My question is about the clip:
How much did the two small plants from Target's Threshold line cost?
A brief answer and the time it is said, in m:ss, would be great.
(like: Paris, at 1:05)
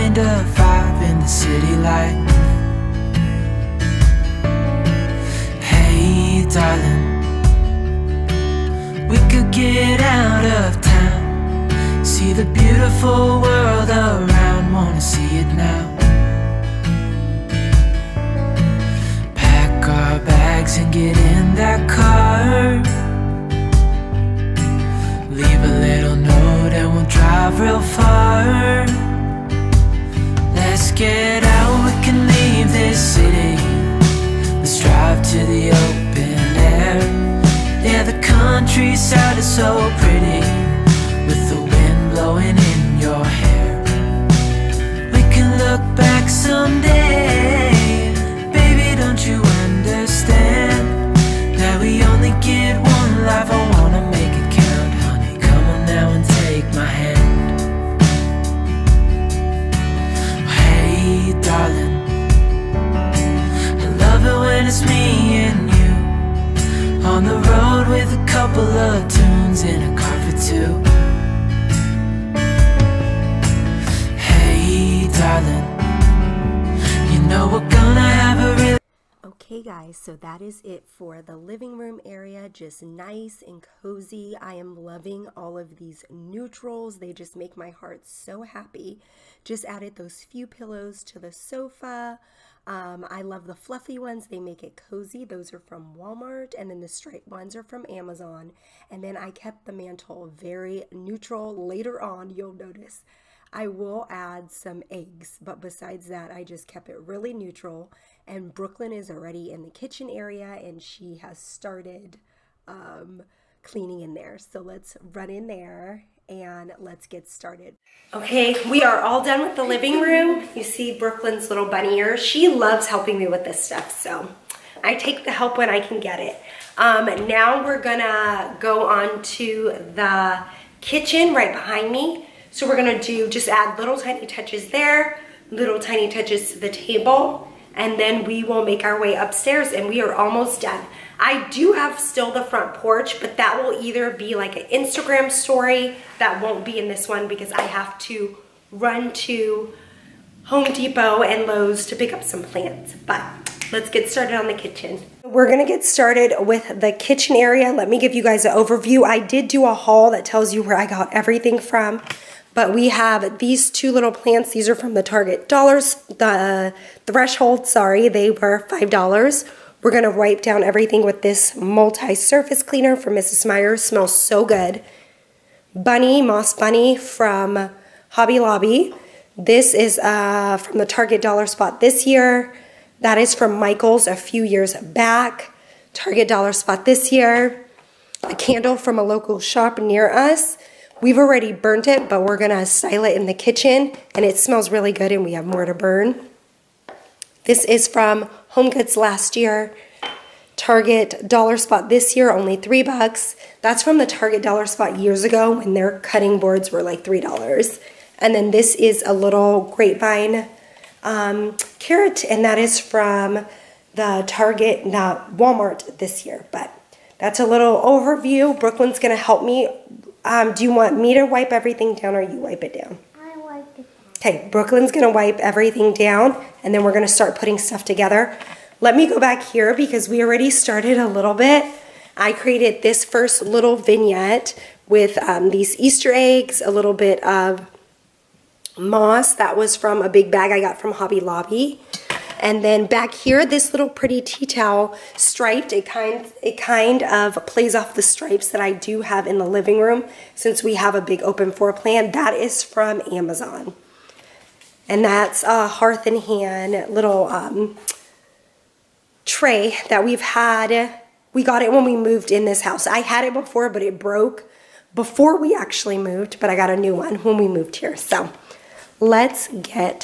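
$5, at 2:48.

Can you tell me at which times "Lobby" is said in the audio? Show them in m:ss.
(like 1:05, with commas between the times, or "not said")
2:58, 4:01.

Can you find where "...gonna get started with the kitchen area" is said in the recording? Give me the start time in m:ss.
2:35.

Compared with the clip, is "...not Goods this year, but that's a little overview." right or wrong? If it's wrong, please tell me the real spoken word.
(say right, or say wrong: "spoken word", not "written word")
wrong: "Walmart", not "Goods".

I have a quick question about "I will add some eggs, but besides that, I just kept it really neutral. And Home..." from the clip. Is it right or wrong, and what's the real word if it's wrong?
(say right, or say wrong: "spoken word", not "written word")
wrong: "Brooklyn", not "Home".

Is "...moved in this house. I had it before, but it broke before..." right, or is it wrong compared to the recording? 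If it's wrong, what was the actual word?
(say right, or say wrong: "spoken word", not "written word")
right.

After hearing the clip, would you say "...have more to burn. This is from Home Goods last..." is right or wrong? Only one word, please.
right.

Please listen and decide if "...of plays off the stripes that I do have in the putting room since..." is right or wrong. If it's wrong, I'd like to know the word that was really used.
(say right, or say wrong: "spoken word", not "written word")
wrong: "living", not "putting".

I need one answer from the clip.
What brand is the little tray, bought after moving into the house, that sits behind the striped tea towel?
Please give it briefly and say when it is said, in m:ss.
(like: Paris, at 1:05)
Hearth and Hand, at 4:15.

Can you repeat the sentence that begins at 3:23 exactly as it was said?
That's from the Target Dollar Spot years ago when their cutting boards were like $3.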